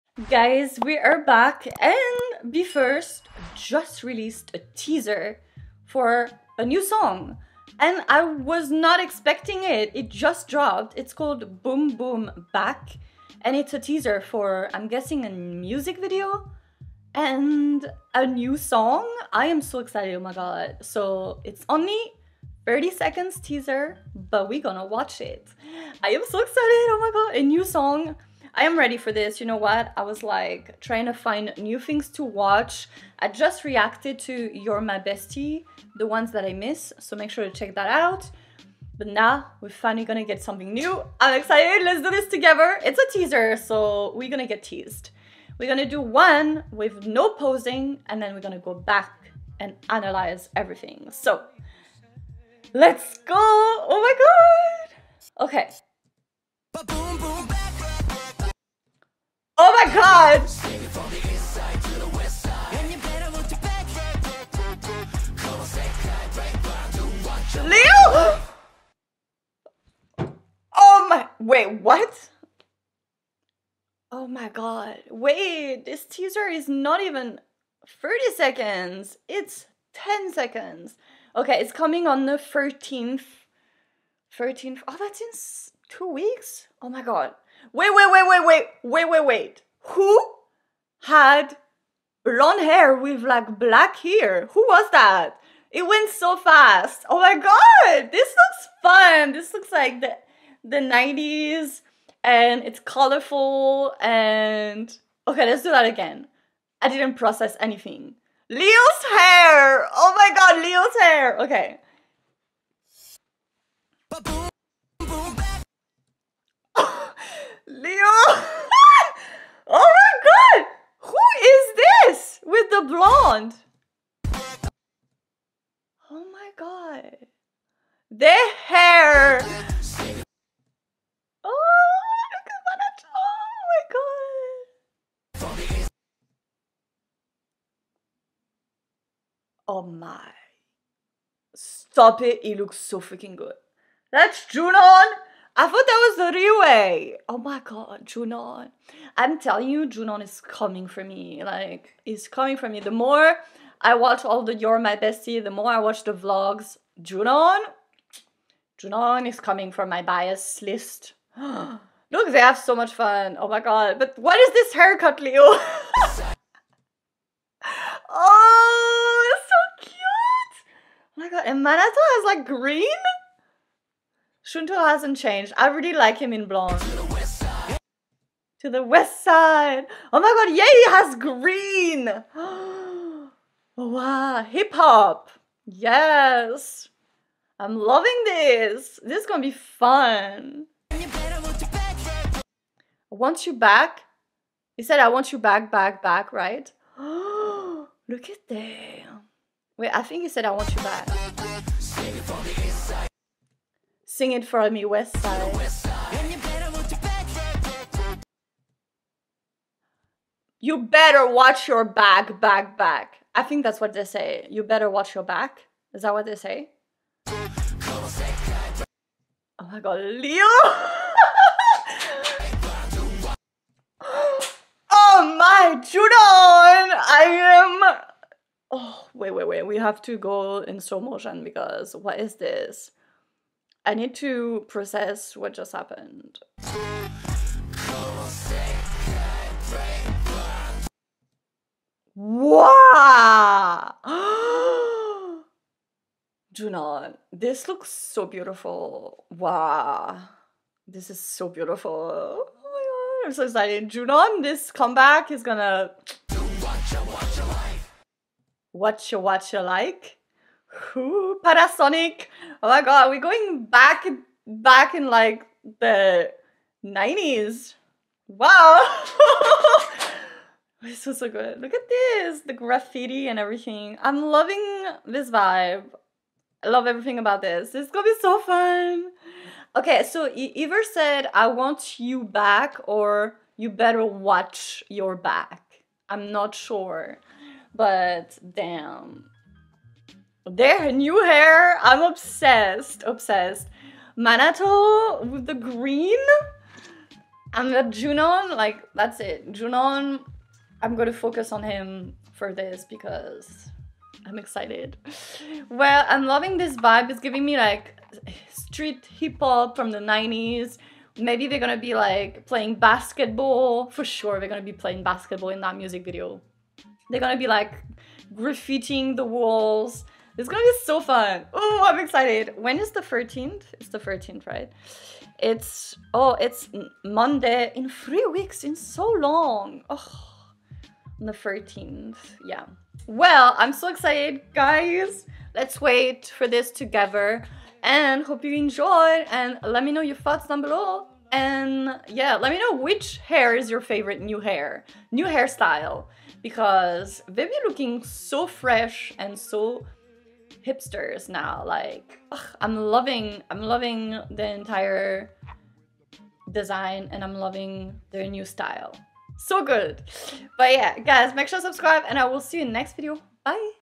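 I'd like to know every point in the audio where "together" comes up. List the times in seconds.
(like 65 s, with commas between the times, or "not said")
42 s, 336 s.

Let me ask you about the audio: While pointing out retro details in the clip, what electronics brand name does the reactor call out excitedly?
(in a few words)
Panasonic.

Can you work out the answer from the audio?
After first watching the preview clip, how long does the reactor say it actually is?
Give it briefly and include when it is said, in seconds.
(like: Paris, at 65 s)
10 seconds, at 79 s.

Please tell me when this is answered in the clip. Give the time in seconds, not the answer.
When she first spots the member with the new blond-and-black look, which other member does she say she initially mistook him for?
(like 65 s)
146 s.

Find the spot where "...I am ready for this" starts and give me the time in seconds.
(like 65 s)
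28 s.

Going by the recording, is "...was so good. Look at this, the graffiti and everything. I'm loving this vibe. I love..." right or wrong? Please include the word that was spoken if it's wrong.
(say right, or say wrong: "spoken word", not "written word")
right.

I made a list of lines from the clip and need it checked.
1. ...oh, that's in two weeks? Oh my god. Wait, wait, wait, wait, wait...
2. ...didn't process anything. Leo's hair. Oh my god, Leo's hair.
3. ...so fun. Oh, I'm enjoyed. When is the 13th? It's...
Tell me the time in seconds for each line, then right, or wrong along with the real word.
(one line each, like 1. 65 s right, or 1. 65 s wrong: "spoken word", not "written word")
1. 84 s right
2. 106 s right
3. 320 s wrong: "excited", not "enjoyed".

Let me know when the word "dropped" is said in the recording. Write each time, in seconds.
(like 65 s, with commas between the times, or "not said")
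10 s.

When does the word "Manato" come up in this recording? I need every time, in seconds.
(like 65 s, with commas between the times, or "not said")
171 s, 294 s.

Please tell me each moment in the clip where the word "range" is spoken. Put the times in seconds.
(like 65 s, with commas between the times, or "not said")
not said.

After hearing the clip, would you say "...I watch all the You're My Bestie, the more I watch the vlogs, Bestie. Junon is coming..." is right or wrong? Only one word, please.
wrong.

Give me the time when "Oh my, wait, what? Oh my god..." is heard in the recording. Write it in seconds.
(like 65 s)
70 s.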